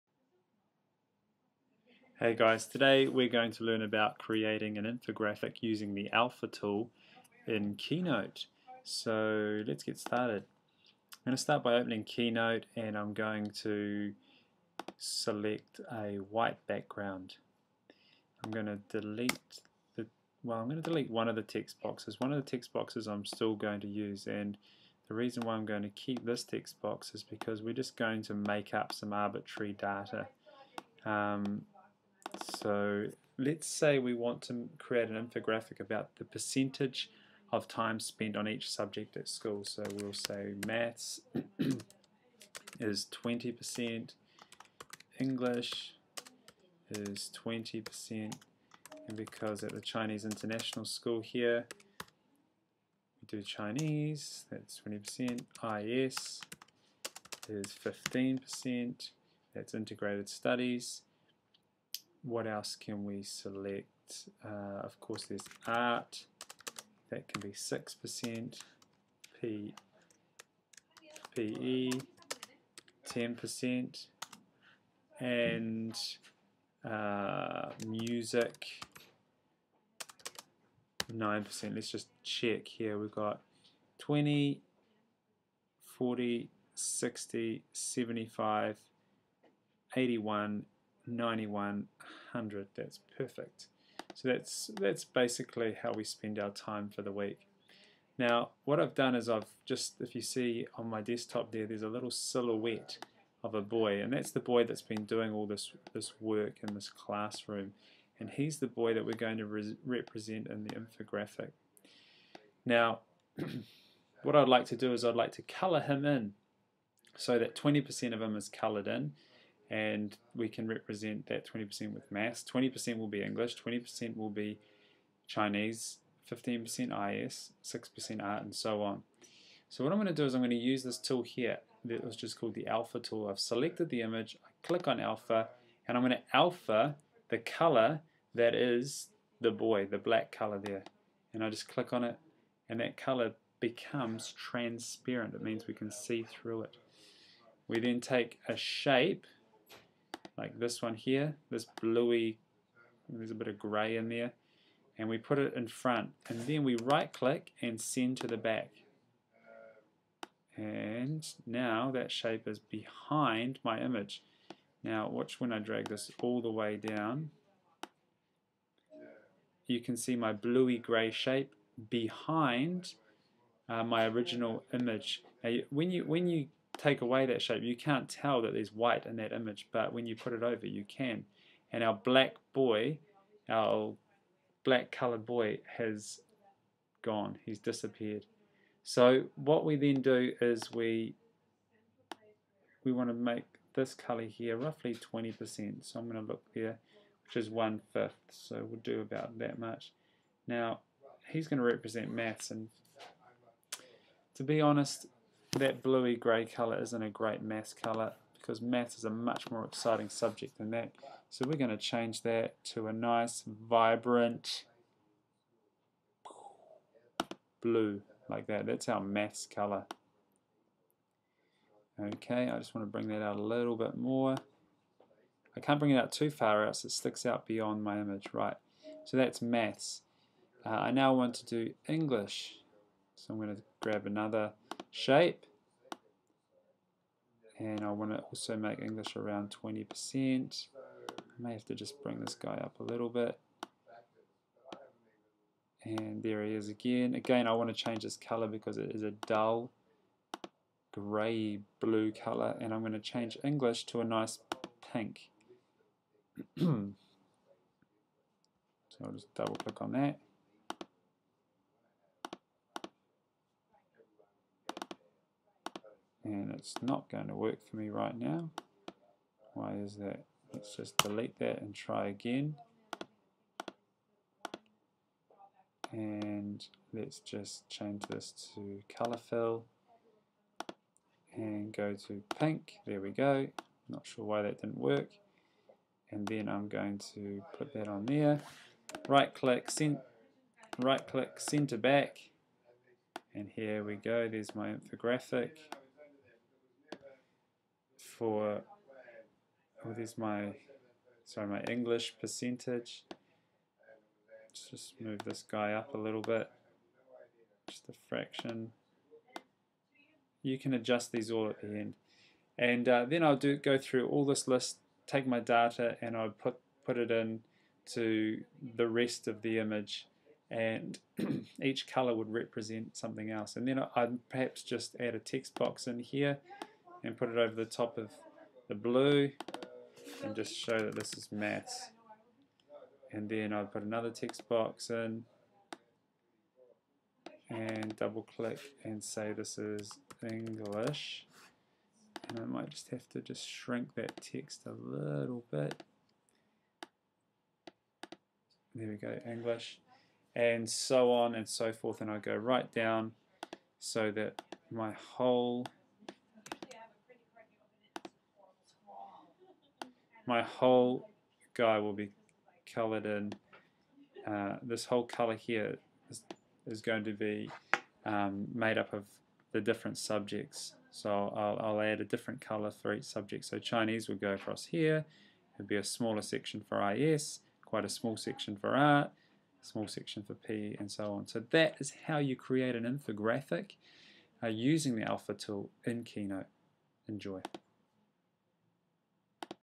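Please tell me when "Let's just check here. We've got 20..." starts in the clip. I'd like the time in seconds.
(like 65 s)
81 s.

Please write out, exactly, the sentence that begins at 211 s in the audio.
So we're going to change that to a nice, vibrant blue like that.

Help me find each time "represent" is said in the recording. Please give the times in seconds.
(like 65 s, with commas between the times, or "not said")
109 s, 120 s, 201 s, 322 s.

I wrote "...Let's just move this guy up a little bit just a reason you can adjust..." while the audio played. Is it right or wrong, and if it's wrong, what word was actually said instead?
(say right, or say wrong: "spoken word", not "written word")
wrong: "fraction", not "reason".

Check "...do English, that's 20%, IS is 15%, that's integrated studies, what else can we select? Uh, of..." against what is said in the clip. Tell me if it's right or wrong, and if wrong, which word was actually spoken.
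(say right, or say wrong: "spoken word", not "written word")
wrong: "Chinese", not "English".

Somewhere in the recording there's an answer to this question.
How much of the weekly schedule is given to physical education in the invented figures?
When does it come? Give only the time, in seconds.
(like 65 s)
73 s.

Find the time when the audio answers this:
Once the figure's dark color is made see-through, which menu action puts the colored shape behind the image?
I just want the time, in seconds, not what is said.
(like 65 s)
157 s.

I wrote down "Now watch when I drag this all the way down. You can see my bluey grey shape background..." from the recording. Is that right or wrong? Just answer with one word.
wrong.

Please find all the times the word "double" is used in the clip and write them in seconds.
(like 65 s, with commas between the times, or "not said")
259 s, 337 s.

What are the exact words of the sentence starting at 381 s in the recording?
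So that is how you create an infographic uh, using the alpha tool in Keynote.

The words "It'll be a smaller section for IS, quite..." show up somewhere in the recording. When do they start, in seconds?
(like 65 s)
375 s.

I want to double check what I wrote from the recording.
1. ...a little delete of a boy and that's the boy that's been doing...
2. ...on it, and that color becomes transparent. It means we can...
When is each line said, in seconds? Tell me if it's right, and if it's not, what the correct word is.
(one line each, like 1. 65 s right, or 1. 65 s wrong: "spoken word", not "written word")
1. 101 s wrong: "silhouette", not "delete"
2. 141 s right.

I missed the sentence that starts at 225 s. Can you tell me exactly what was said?
I can't bring it out too far out so it sticks out beyond my image.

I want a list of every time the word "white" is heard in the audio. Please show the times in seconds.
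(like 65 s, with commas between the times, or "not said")
16 s, 178 s.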